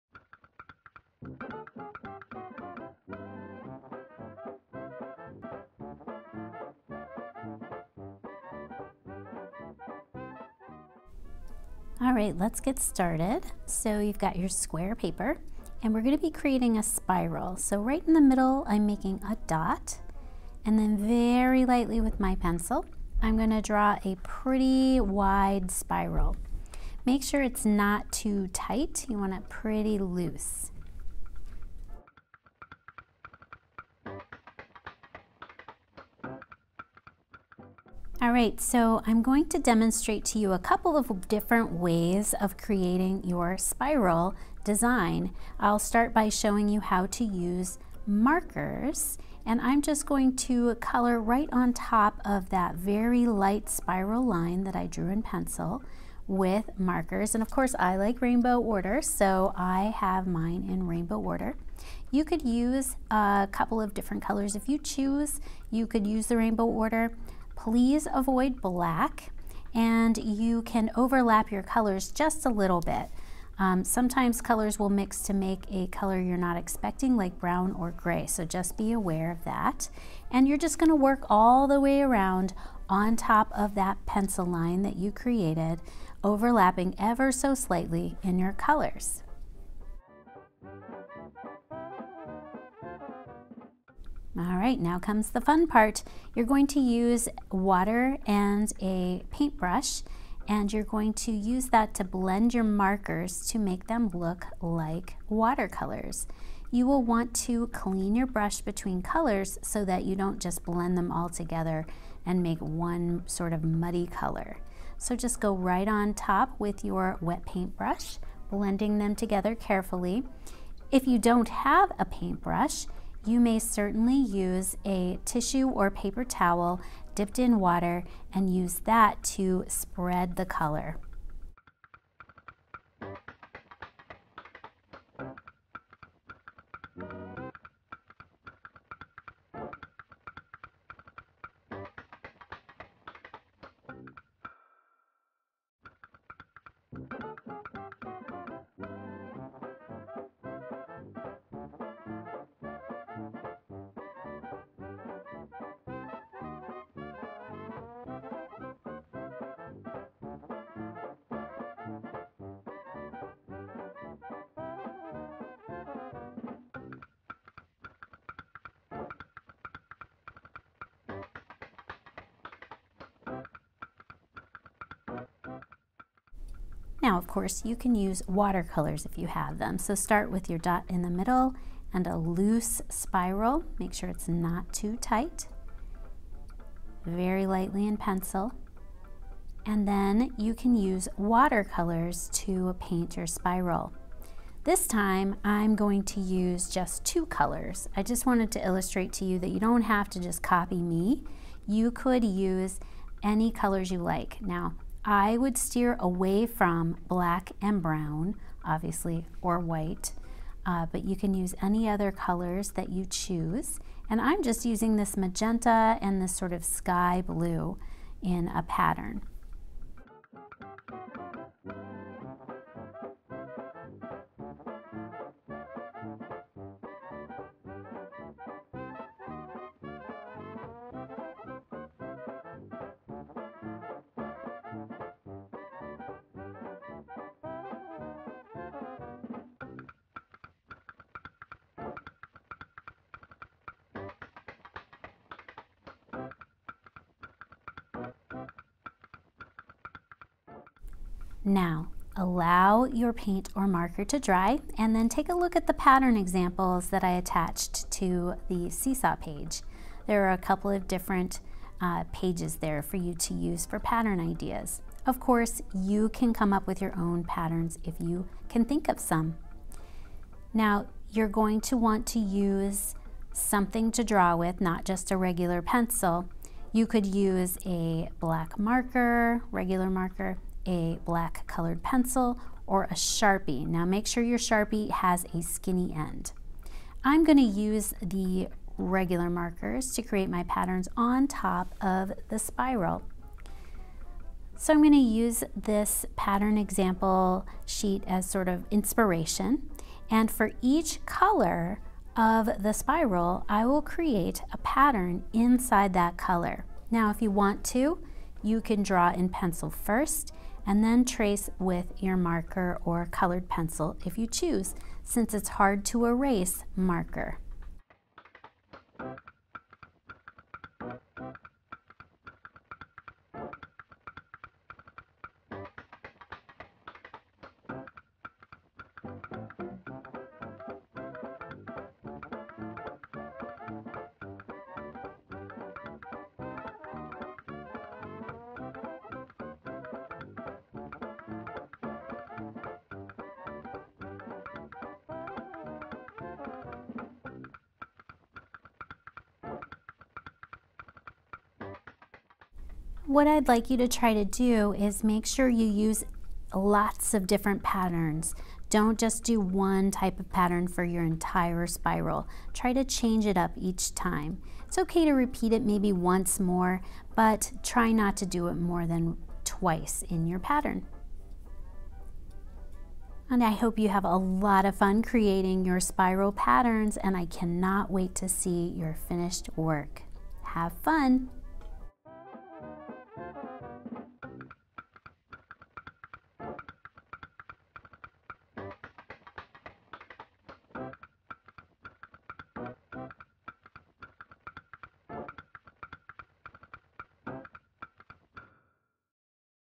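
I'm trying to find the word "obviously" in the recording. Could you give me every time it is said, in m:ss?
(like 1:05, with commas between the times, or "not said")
3:28.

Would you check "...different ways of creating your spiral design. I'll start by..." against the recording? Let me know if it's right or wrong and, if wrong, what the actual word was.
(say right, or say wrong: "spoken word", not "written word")
right.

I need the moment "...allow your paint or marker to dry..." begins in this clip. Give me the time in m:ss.
4:12.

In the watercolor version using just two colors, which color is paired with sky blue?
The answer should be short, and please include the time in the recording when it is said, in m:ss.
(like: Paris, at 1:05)
Magenta, at 3:35.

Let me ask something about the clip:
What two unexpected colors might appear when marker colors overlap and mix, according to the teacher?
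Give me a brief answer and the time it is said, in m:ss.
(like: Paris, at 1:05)
Brown or gray, at 1:17.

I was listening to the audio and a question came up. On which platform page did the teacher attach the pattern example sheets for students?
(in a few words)
Seesaw.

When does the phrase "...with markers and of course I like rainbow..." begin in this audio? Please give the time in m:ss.
0:56.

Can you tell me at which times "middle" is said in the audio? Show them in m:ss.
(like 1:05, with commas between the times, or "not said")
0:18, 3:01.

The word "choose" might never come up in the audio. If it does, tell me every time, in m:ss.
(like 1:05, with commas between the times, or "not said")
1:04, 3:33, 5:14.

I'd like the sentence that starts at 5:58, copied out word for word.
Don't just do one type of pattern for your entire spiral.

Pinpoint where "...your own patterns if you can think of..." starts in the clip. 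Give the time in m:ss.
4:26.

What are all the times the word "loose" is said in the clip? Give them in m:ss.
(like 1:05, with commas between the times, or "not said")
0:29, 3:02.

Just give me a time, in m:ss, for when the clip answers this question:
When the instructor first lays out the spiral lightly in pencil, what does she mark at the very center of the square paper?
0:19.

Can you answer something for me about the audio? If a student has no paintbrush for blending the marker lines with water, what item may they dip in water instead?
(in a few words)
A tissue or paper towel.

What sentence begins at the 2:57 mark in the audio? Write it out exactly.
Now, of course, you can use watercolors if you have them.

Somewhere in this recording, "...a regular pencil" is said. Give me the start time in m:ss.
4:35.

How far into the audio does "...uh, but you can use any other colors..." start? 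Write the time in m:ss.
3:30.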